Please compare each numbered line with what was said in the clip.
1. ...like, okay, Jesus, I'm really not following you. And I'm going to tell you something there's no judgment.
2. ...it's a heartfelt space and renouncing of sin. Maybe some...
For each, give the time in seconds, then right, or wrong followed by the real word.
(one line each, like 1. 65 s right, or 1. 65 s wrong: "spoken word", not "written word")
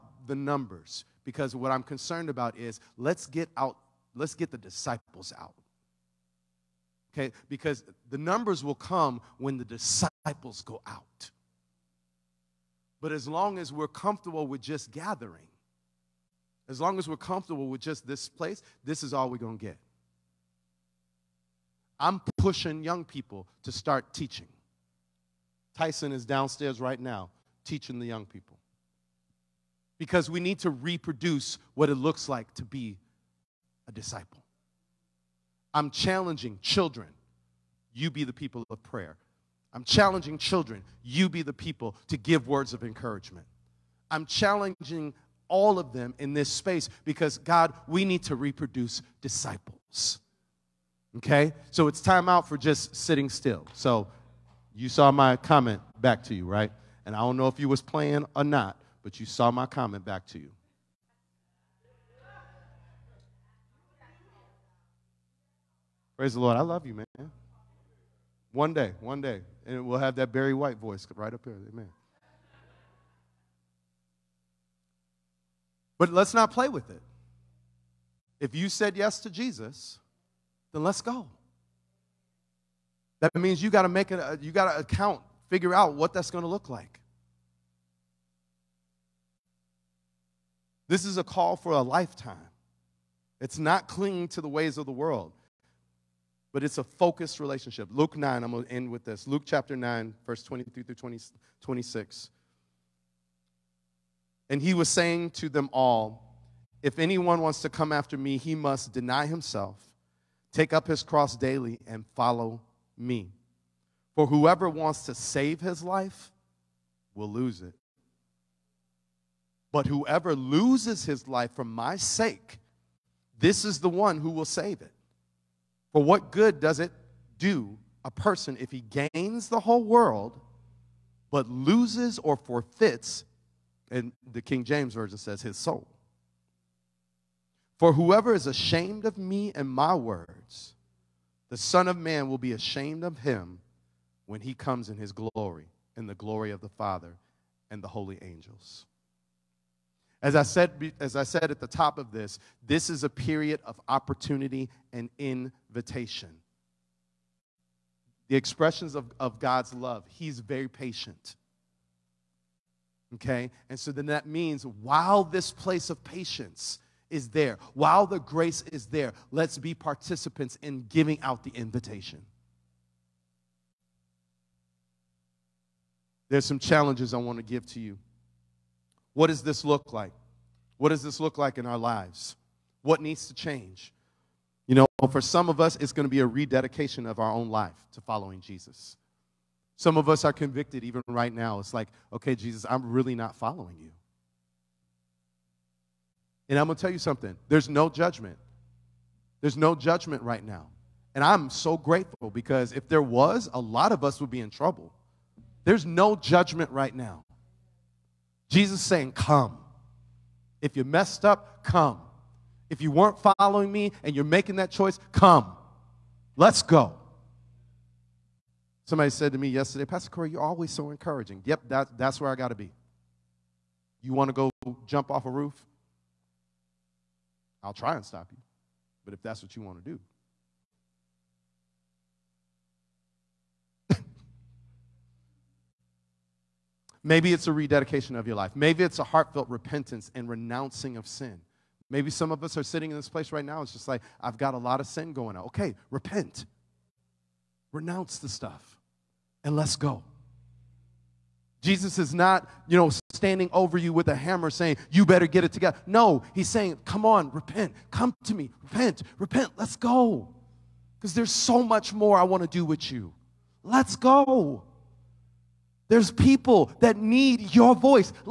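1. 191 s right
2. 238 s wrong: "repentance", not "space".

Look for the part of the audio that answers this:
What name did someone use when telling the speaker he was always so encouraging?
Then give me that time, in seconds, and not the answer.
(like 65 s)
219 s.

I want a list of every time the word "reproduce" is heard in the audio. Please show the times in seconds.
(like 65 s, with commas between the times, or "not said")
30 s, 48 s.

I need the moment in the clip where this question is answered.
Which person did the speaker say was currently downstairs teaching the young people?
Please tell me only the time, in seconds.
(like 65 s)
25 s.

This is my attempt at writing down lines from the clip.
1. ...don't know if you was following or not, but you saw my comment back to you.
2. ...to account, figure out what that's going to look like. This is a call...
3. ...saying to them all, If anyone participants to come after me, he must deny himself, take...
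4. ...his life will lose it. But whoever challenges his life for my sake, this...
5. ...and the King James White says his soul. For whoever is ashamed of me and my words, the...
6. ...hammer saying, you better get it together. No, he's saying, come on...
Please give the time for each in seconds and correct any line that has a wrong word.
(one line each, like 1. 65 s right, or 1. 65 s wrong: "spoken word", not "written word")
1. 57 s wrong: "playing", not "following"
2. 84 s right
3. 104 s wrong: "wants", not "participants"
4. 115 s wrong: "loses", not "challenges"
5. 133 s wrong: "Version", not "White"
6. 254 s right.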